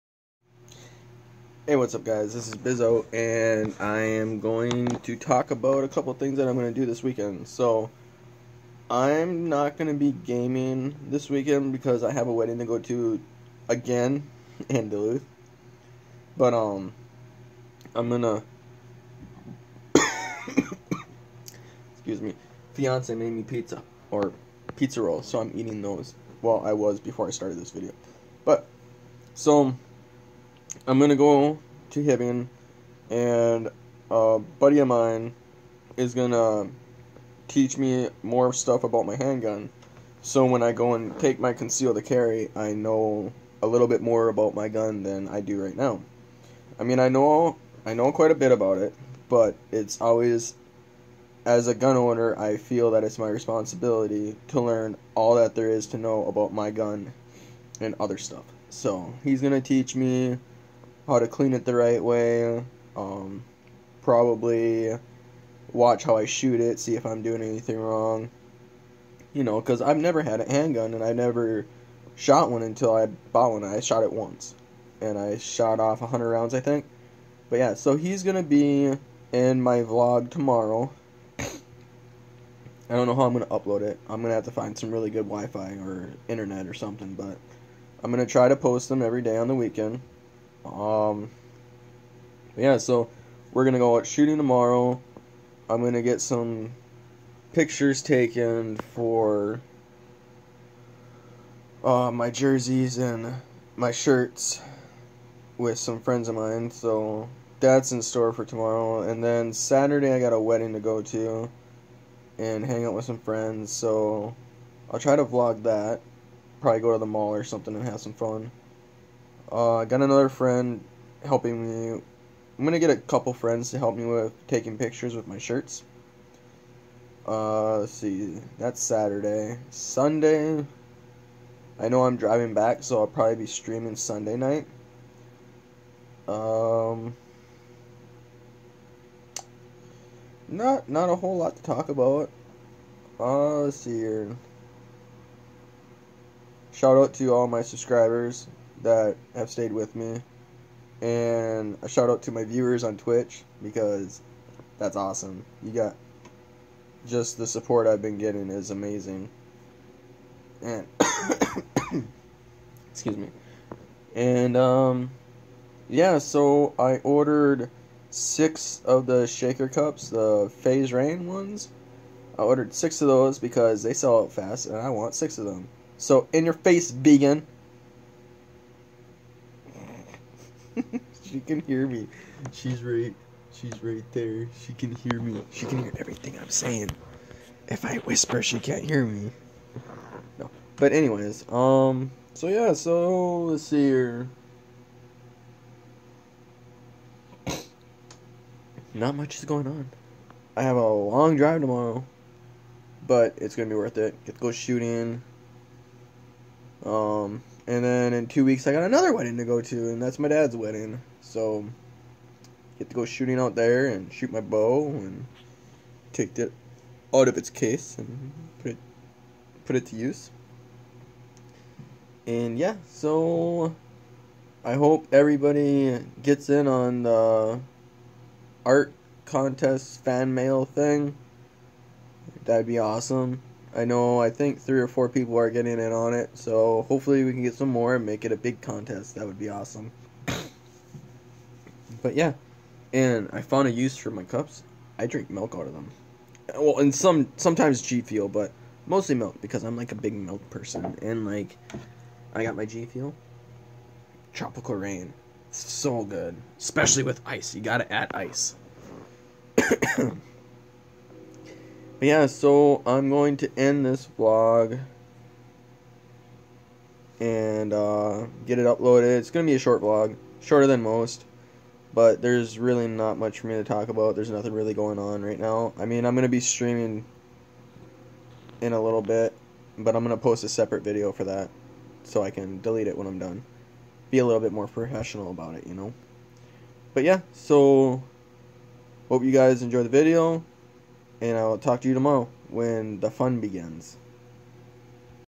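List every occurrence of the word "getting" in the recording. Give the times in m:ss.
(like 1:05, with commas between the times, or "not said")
2:38, 3:55.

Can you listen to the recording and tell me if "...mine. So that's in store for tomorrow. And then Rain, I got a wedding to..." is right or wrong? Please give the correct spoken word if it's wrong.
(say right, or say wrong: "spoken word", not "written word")
wrong: "Saturday", not "Rain".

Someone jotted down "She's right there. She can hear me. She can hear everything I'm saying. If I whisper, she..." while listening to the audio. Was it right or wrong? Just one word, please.
right.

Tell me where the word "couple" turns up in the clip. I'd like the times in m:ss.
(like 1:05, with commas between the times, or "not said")
0:05, 2:02.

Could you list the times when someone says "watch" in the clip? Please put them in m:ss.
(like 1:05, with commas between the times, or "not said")
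1:05.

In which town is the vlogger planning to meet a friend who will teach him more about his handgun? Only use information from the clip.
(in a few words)
Hibbing.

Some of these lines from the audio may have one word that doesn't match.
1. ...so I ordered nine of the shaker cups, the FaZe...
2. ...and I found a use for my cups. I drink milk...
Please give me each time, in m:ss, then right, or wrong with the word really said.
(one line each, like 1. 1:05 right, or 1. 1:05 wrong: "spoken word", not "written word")
1. 2:46 wrong: "six", not "nine"
2. 4:02 right.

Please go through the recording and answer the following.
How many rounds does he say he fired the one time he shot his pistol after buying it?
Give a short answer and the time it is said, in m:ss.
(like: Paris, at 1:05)
100, at 1:16.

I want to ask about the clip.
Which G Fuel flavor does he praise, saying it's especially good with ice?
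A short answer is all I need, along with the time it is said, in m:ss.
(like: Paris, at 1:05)
Tropical rain, at 4:14.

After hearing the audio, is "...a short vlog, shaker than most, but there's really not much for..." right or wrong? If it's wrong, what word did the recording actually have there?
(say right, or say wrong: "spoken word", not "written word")
wrong: "shorter", not "shaker".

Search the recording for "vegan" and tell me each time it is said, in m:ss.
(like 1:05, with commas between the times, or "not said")
2:56.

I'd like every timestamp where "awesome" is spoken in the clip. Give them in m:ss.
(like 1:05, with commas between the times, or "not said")
2:34, 3:52, 3:59.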